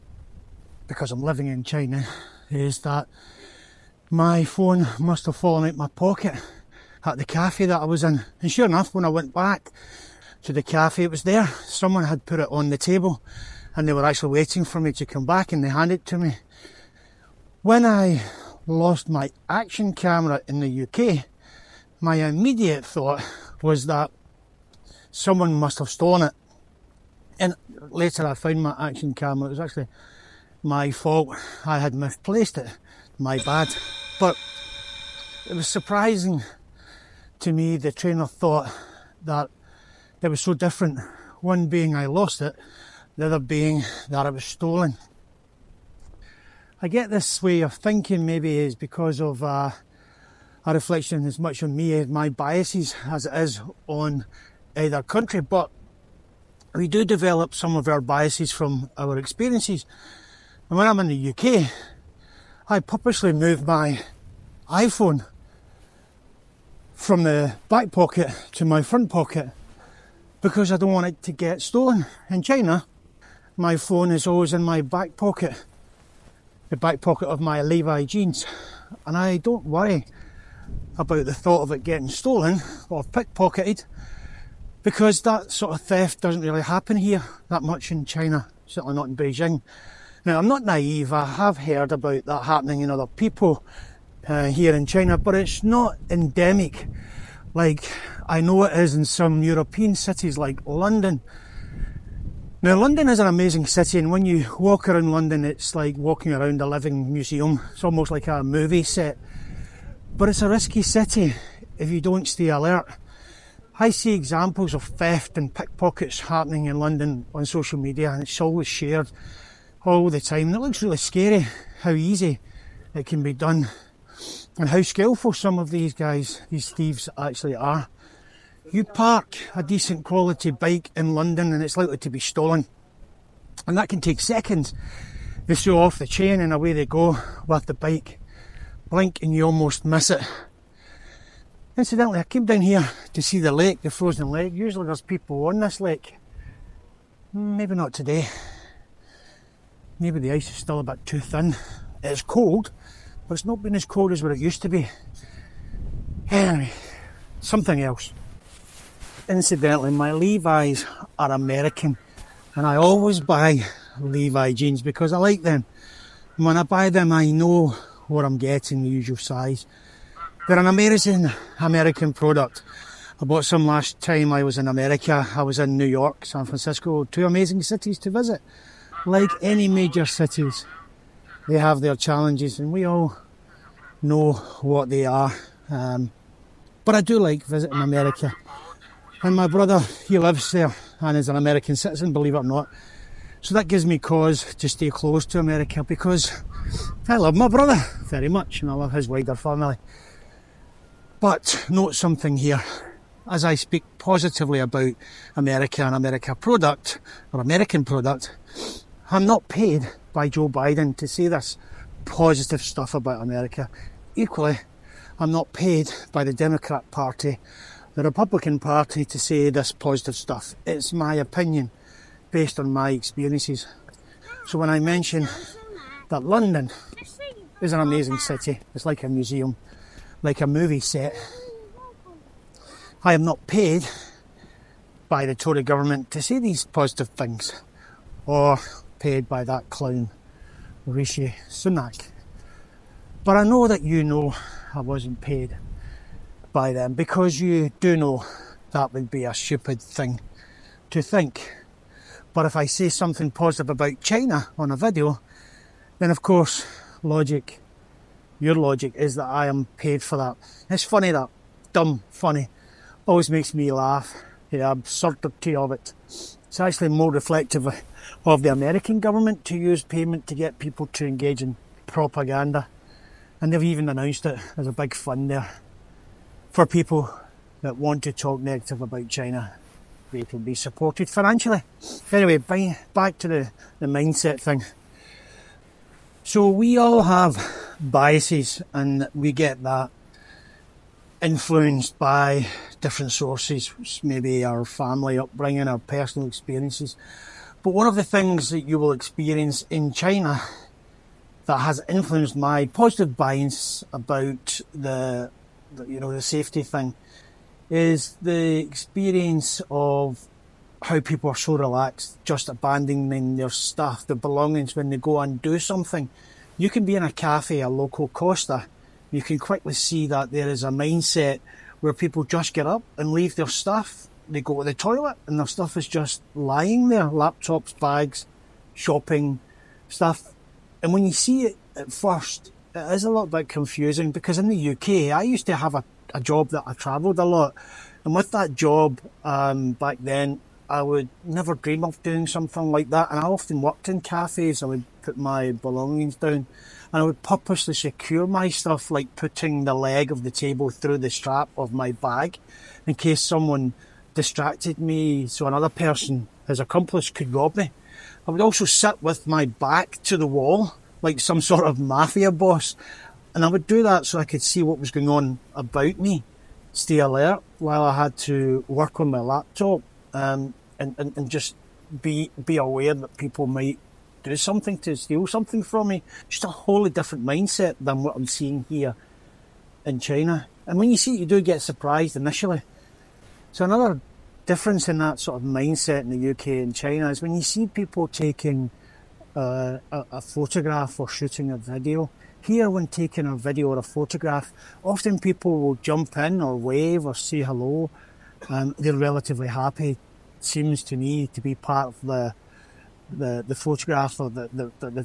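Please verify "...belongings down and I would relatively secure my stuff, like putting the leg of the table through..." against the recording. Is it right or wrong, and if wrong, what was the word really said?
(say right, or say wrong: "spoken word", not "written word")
wrong: "purposely", not "relatively".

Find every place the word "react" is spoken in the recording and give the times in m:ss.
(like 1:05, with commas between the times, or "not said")
not said.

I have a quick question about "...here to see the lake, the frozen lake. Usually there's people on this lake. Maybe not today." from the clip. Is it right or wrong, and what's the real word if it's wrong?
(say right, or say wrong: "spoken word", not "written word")
right.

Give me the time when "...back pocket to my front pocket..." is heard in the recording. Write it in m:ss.
1:07.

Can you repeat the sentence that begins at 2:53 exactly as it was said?
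I bought some last time I was in America.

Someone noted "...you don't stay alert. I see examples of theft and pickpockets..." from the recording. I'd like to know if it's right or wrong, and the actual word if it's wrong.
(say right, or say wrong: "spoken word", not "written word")
right.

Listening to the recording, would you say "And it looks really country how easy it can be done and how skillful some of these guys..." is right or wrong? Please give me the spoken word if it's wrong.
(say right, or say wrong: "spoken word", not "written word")
wrong: "scary", not "country".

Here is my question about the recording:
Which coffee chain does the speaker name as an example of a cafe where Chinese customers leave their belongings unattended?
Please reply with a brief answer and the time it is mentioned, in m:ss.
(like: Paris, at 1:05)
Costa, at 5:18.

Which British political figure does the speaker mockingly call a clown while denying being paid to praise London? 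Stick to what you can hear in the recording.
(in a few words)
Rishi Sunak.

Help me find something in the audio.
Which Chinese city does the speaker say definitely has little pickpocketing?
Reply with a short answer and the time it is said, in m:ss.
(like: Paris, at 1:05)
Beijing, at 1:29.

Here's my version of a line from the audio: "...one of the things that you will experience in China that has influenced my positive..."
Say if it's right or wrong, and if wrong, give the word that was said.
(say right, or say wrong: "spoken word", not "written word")
right.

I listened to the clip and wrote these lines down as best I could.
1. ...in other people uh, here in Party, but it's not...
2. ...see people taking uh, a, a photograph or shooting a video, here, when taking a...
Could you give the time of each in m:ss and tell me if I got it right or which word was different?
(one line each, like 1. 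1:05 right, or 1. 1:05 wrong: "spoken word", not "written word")
1. 1:32 wrong: "China", not "Party"
2. 6:27 right.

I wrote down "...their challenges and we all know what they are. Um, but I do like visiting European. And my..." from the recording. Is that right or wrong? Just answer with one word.
wrong.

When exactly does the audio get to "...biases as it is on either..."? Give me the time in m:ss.
0:52.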